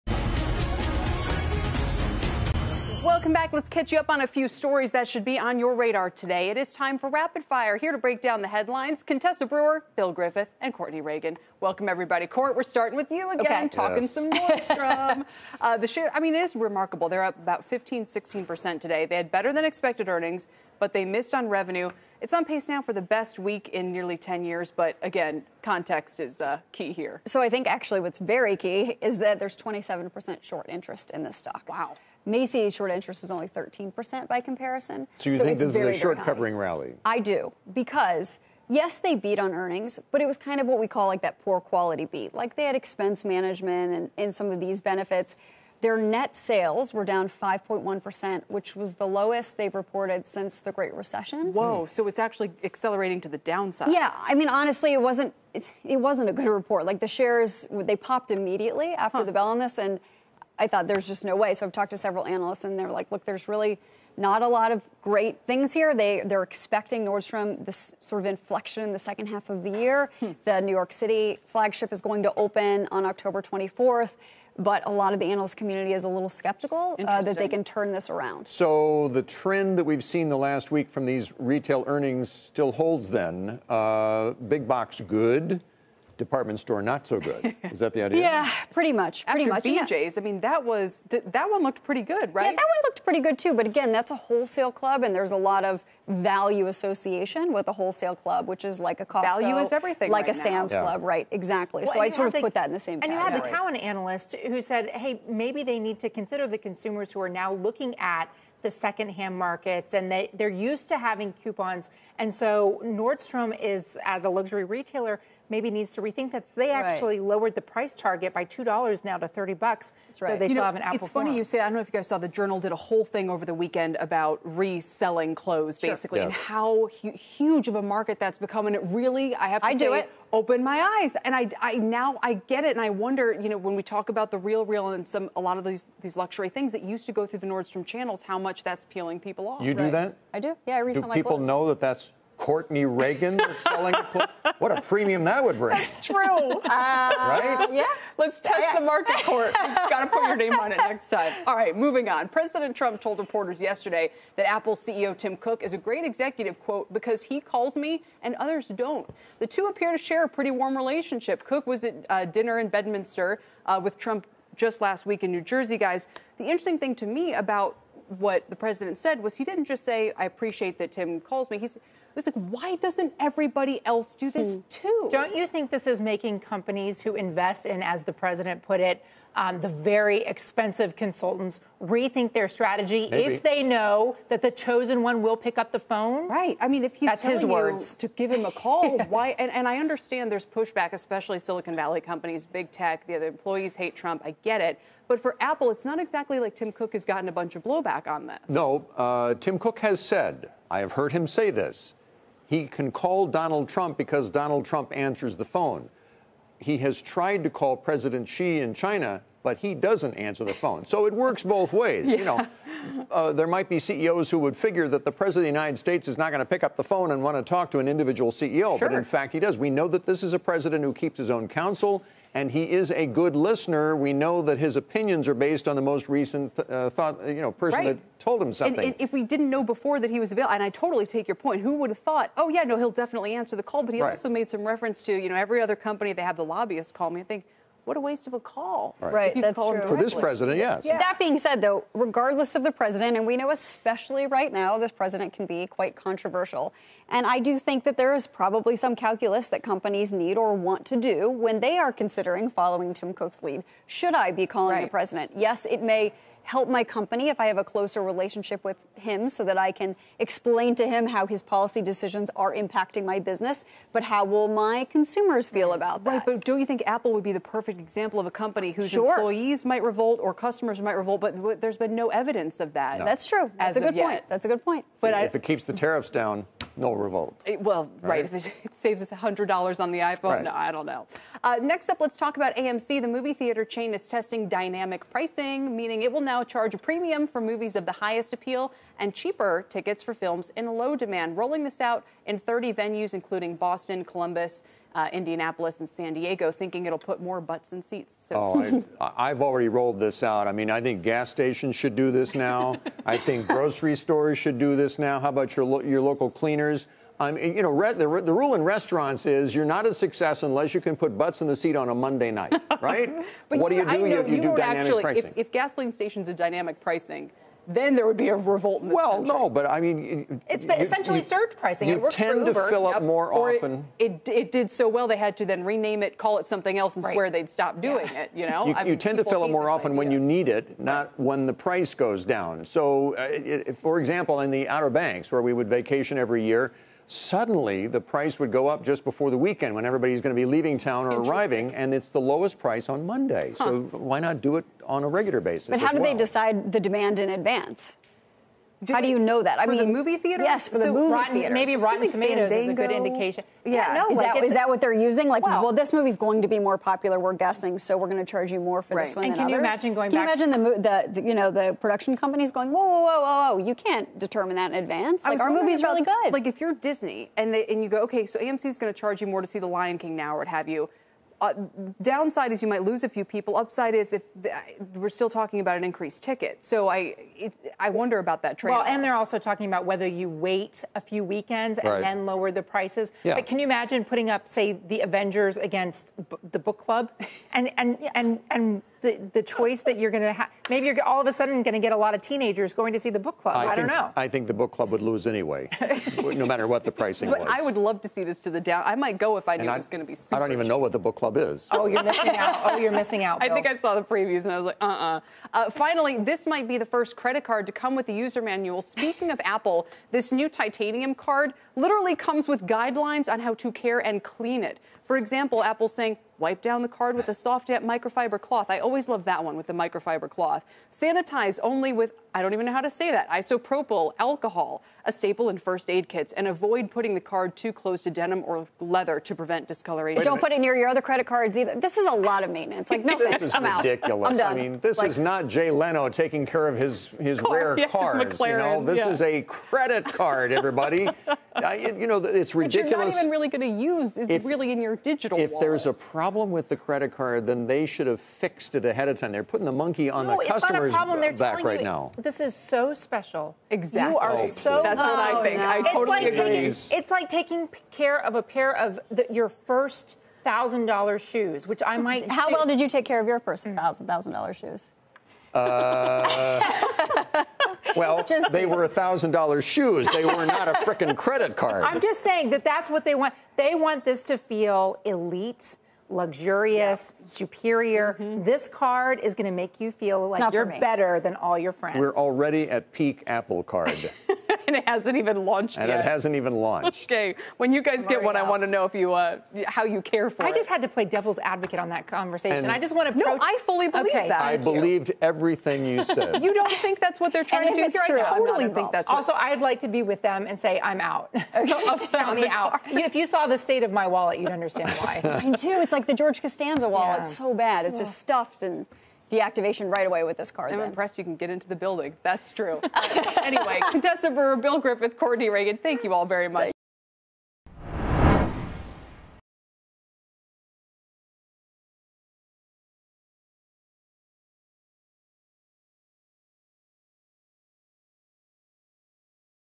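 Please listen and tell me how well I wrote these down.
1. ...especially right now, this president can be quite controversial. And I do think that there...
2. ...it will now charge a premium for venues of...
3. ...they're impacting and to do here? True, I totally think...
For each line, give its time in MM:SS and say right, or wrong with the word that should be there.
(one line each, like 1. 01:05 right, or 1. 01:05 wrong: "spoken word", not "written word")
1. 04:03 right
2. 04:46 wrong: "movies", not "venues"
3. 08:17 wrong: "trying", not "impacting".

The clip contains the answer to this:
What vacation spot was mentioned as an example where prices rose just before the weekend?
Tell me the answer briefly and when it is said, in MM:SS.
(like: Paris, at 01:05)
Outer Banks, at 05:34.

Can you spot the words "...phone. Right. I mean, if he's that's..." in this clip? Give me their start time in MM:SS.
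03:05.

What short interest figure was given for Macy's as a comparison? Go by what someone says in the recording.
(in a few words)
13%.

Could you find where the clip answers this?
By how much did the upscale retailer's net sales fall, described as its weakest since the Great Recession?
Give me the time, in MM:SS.
00:47.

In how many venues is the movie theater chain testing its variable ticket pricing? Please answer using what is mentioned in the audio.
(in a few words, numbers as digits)
30.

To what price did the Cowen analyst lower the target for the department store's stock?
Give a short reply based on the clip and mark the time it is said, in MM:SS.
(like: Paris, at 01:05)
$30, at 01:59.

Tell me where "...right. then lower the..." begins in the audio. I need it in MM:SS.
06:21.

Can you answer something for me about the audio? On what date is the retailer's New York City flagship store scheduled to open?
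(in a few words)
October 24th.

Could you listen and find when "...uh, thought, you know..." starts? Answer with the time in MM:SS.
03:46.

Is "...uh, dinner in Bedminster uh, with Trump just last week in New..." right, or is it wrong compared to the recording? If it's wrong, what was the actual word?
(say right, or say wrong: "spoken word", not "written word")
right.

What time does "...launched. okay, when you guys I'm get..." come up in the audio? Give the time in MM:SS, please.
08:06.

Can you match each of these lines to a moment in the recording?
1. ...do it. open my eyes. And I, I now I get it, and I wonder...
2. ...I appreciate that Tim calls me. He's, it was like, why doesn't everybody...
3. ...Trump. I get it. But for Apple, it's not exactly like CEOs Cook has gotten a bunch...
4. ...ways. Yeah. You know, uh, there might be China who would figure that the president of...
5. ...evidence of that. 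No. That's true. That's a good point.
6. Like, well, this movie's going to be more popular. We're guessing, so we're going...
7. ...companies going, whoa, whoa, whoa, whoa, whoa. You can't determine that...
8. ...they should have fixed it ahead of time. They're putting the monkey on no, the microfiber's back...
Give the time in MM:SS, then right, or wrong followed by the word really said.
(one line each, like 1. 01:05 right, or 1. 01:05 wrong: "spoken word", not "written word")
1. 02:09 right
2. 02:50 right
3. 03:13 wrong: "Tim", not "CEOs"
4. 03:31 wrong: "CEOs", not "China"
5. 04:32 right
6. 05:55 right
7. 06:02 right
8. 07:27 wrong: "customer", not "microfiber".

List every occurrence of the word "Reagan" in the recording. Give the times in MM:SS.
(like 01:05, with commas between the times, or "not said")
00:11, 02:22, 08:35.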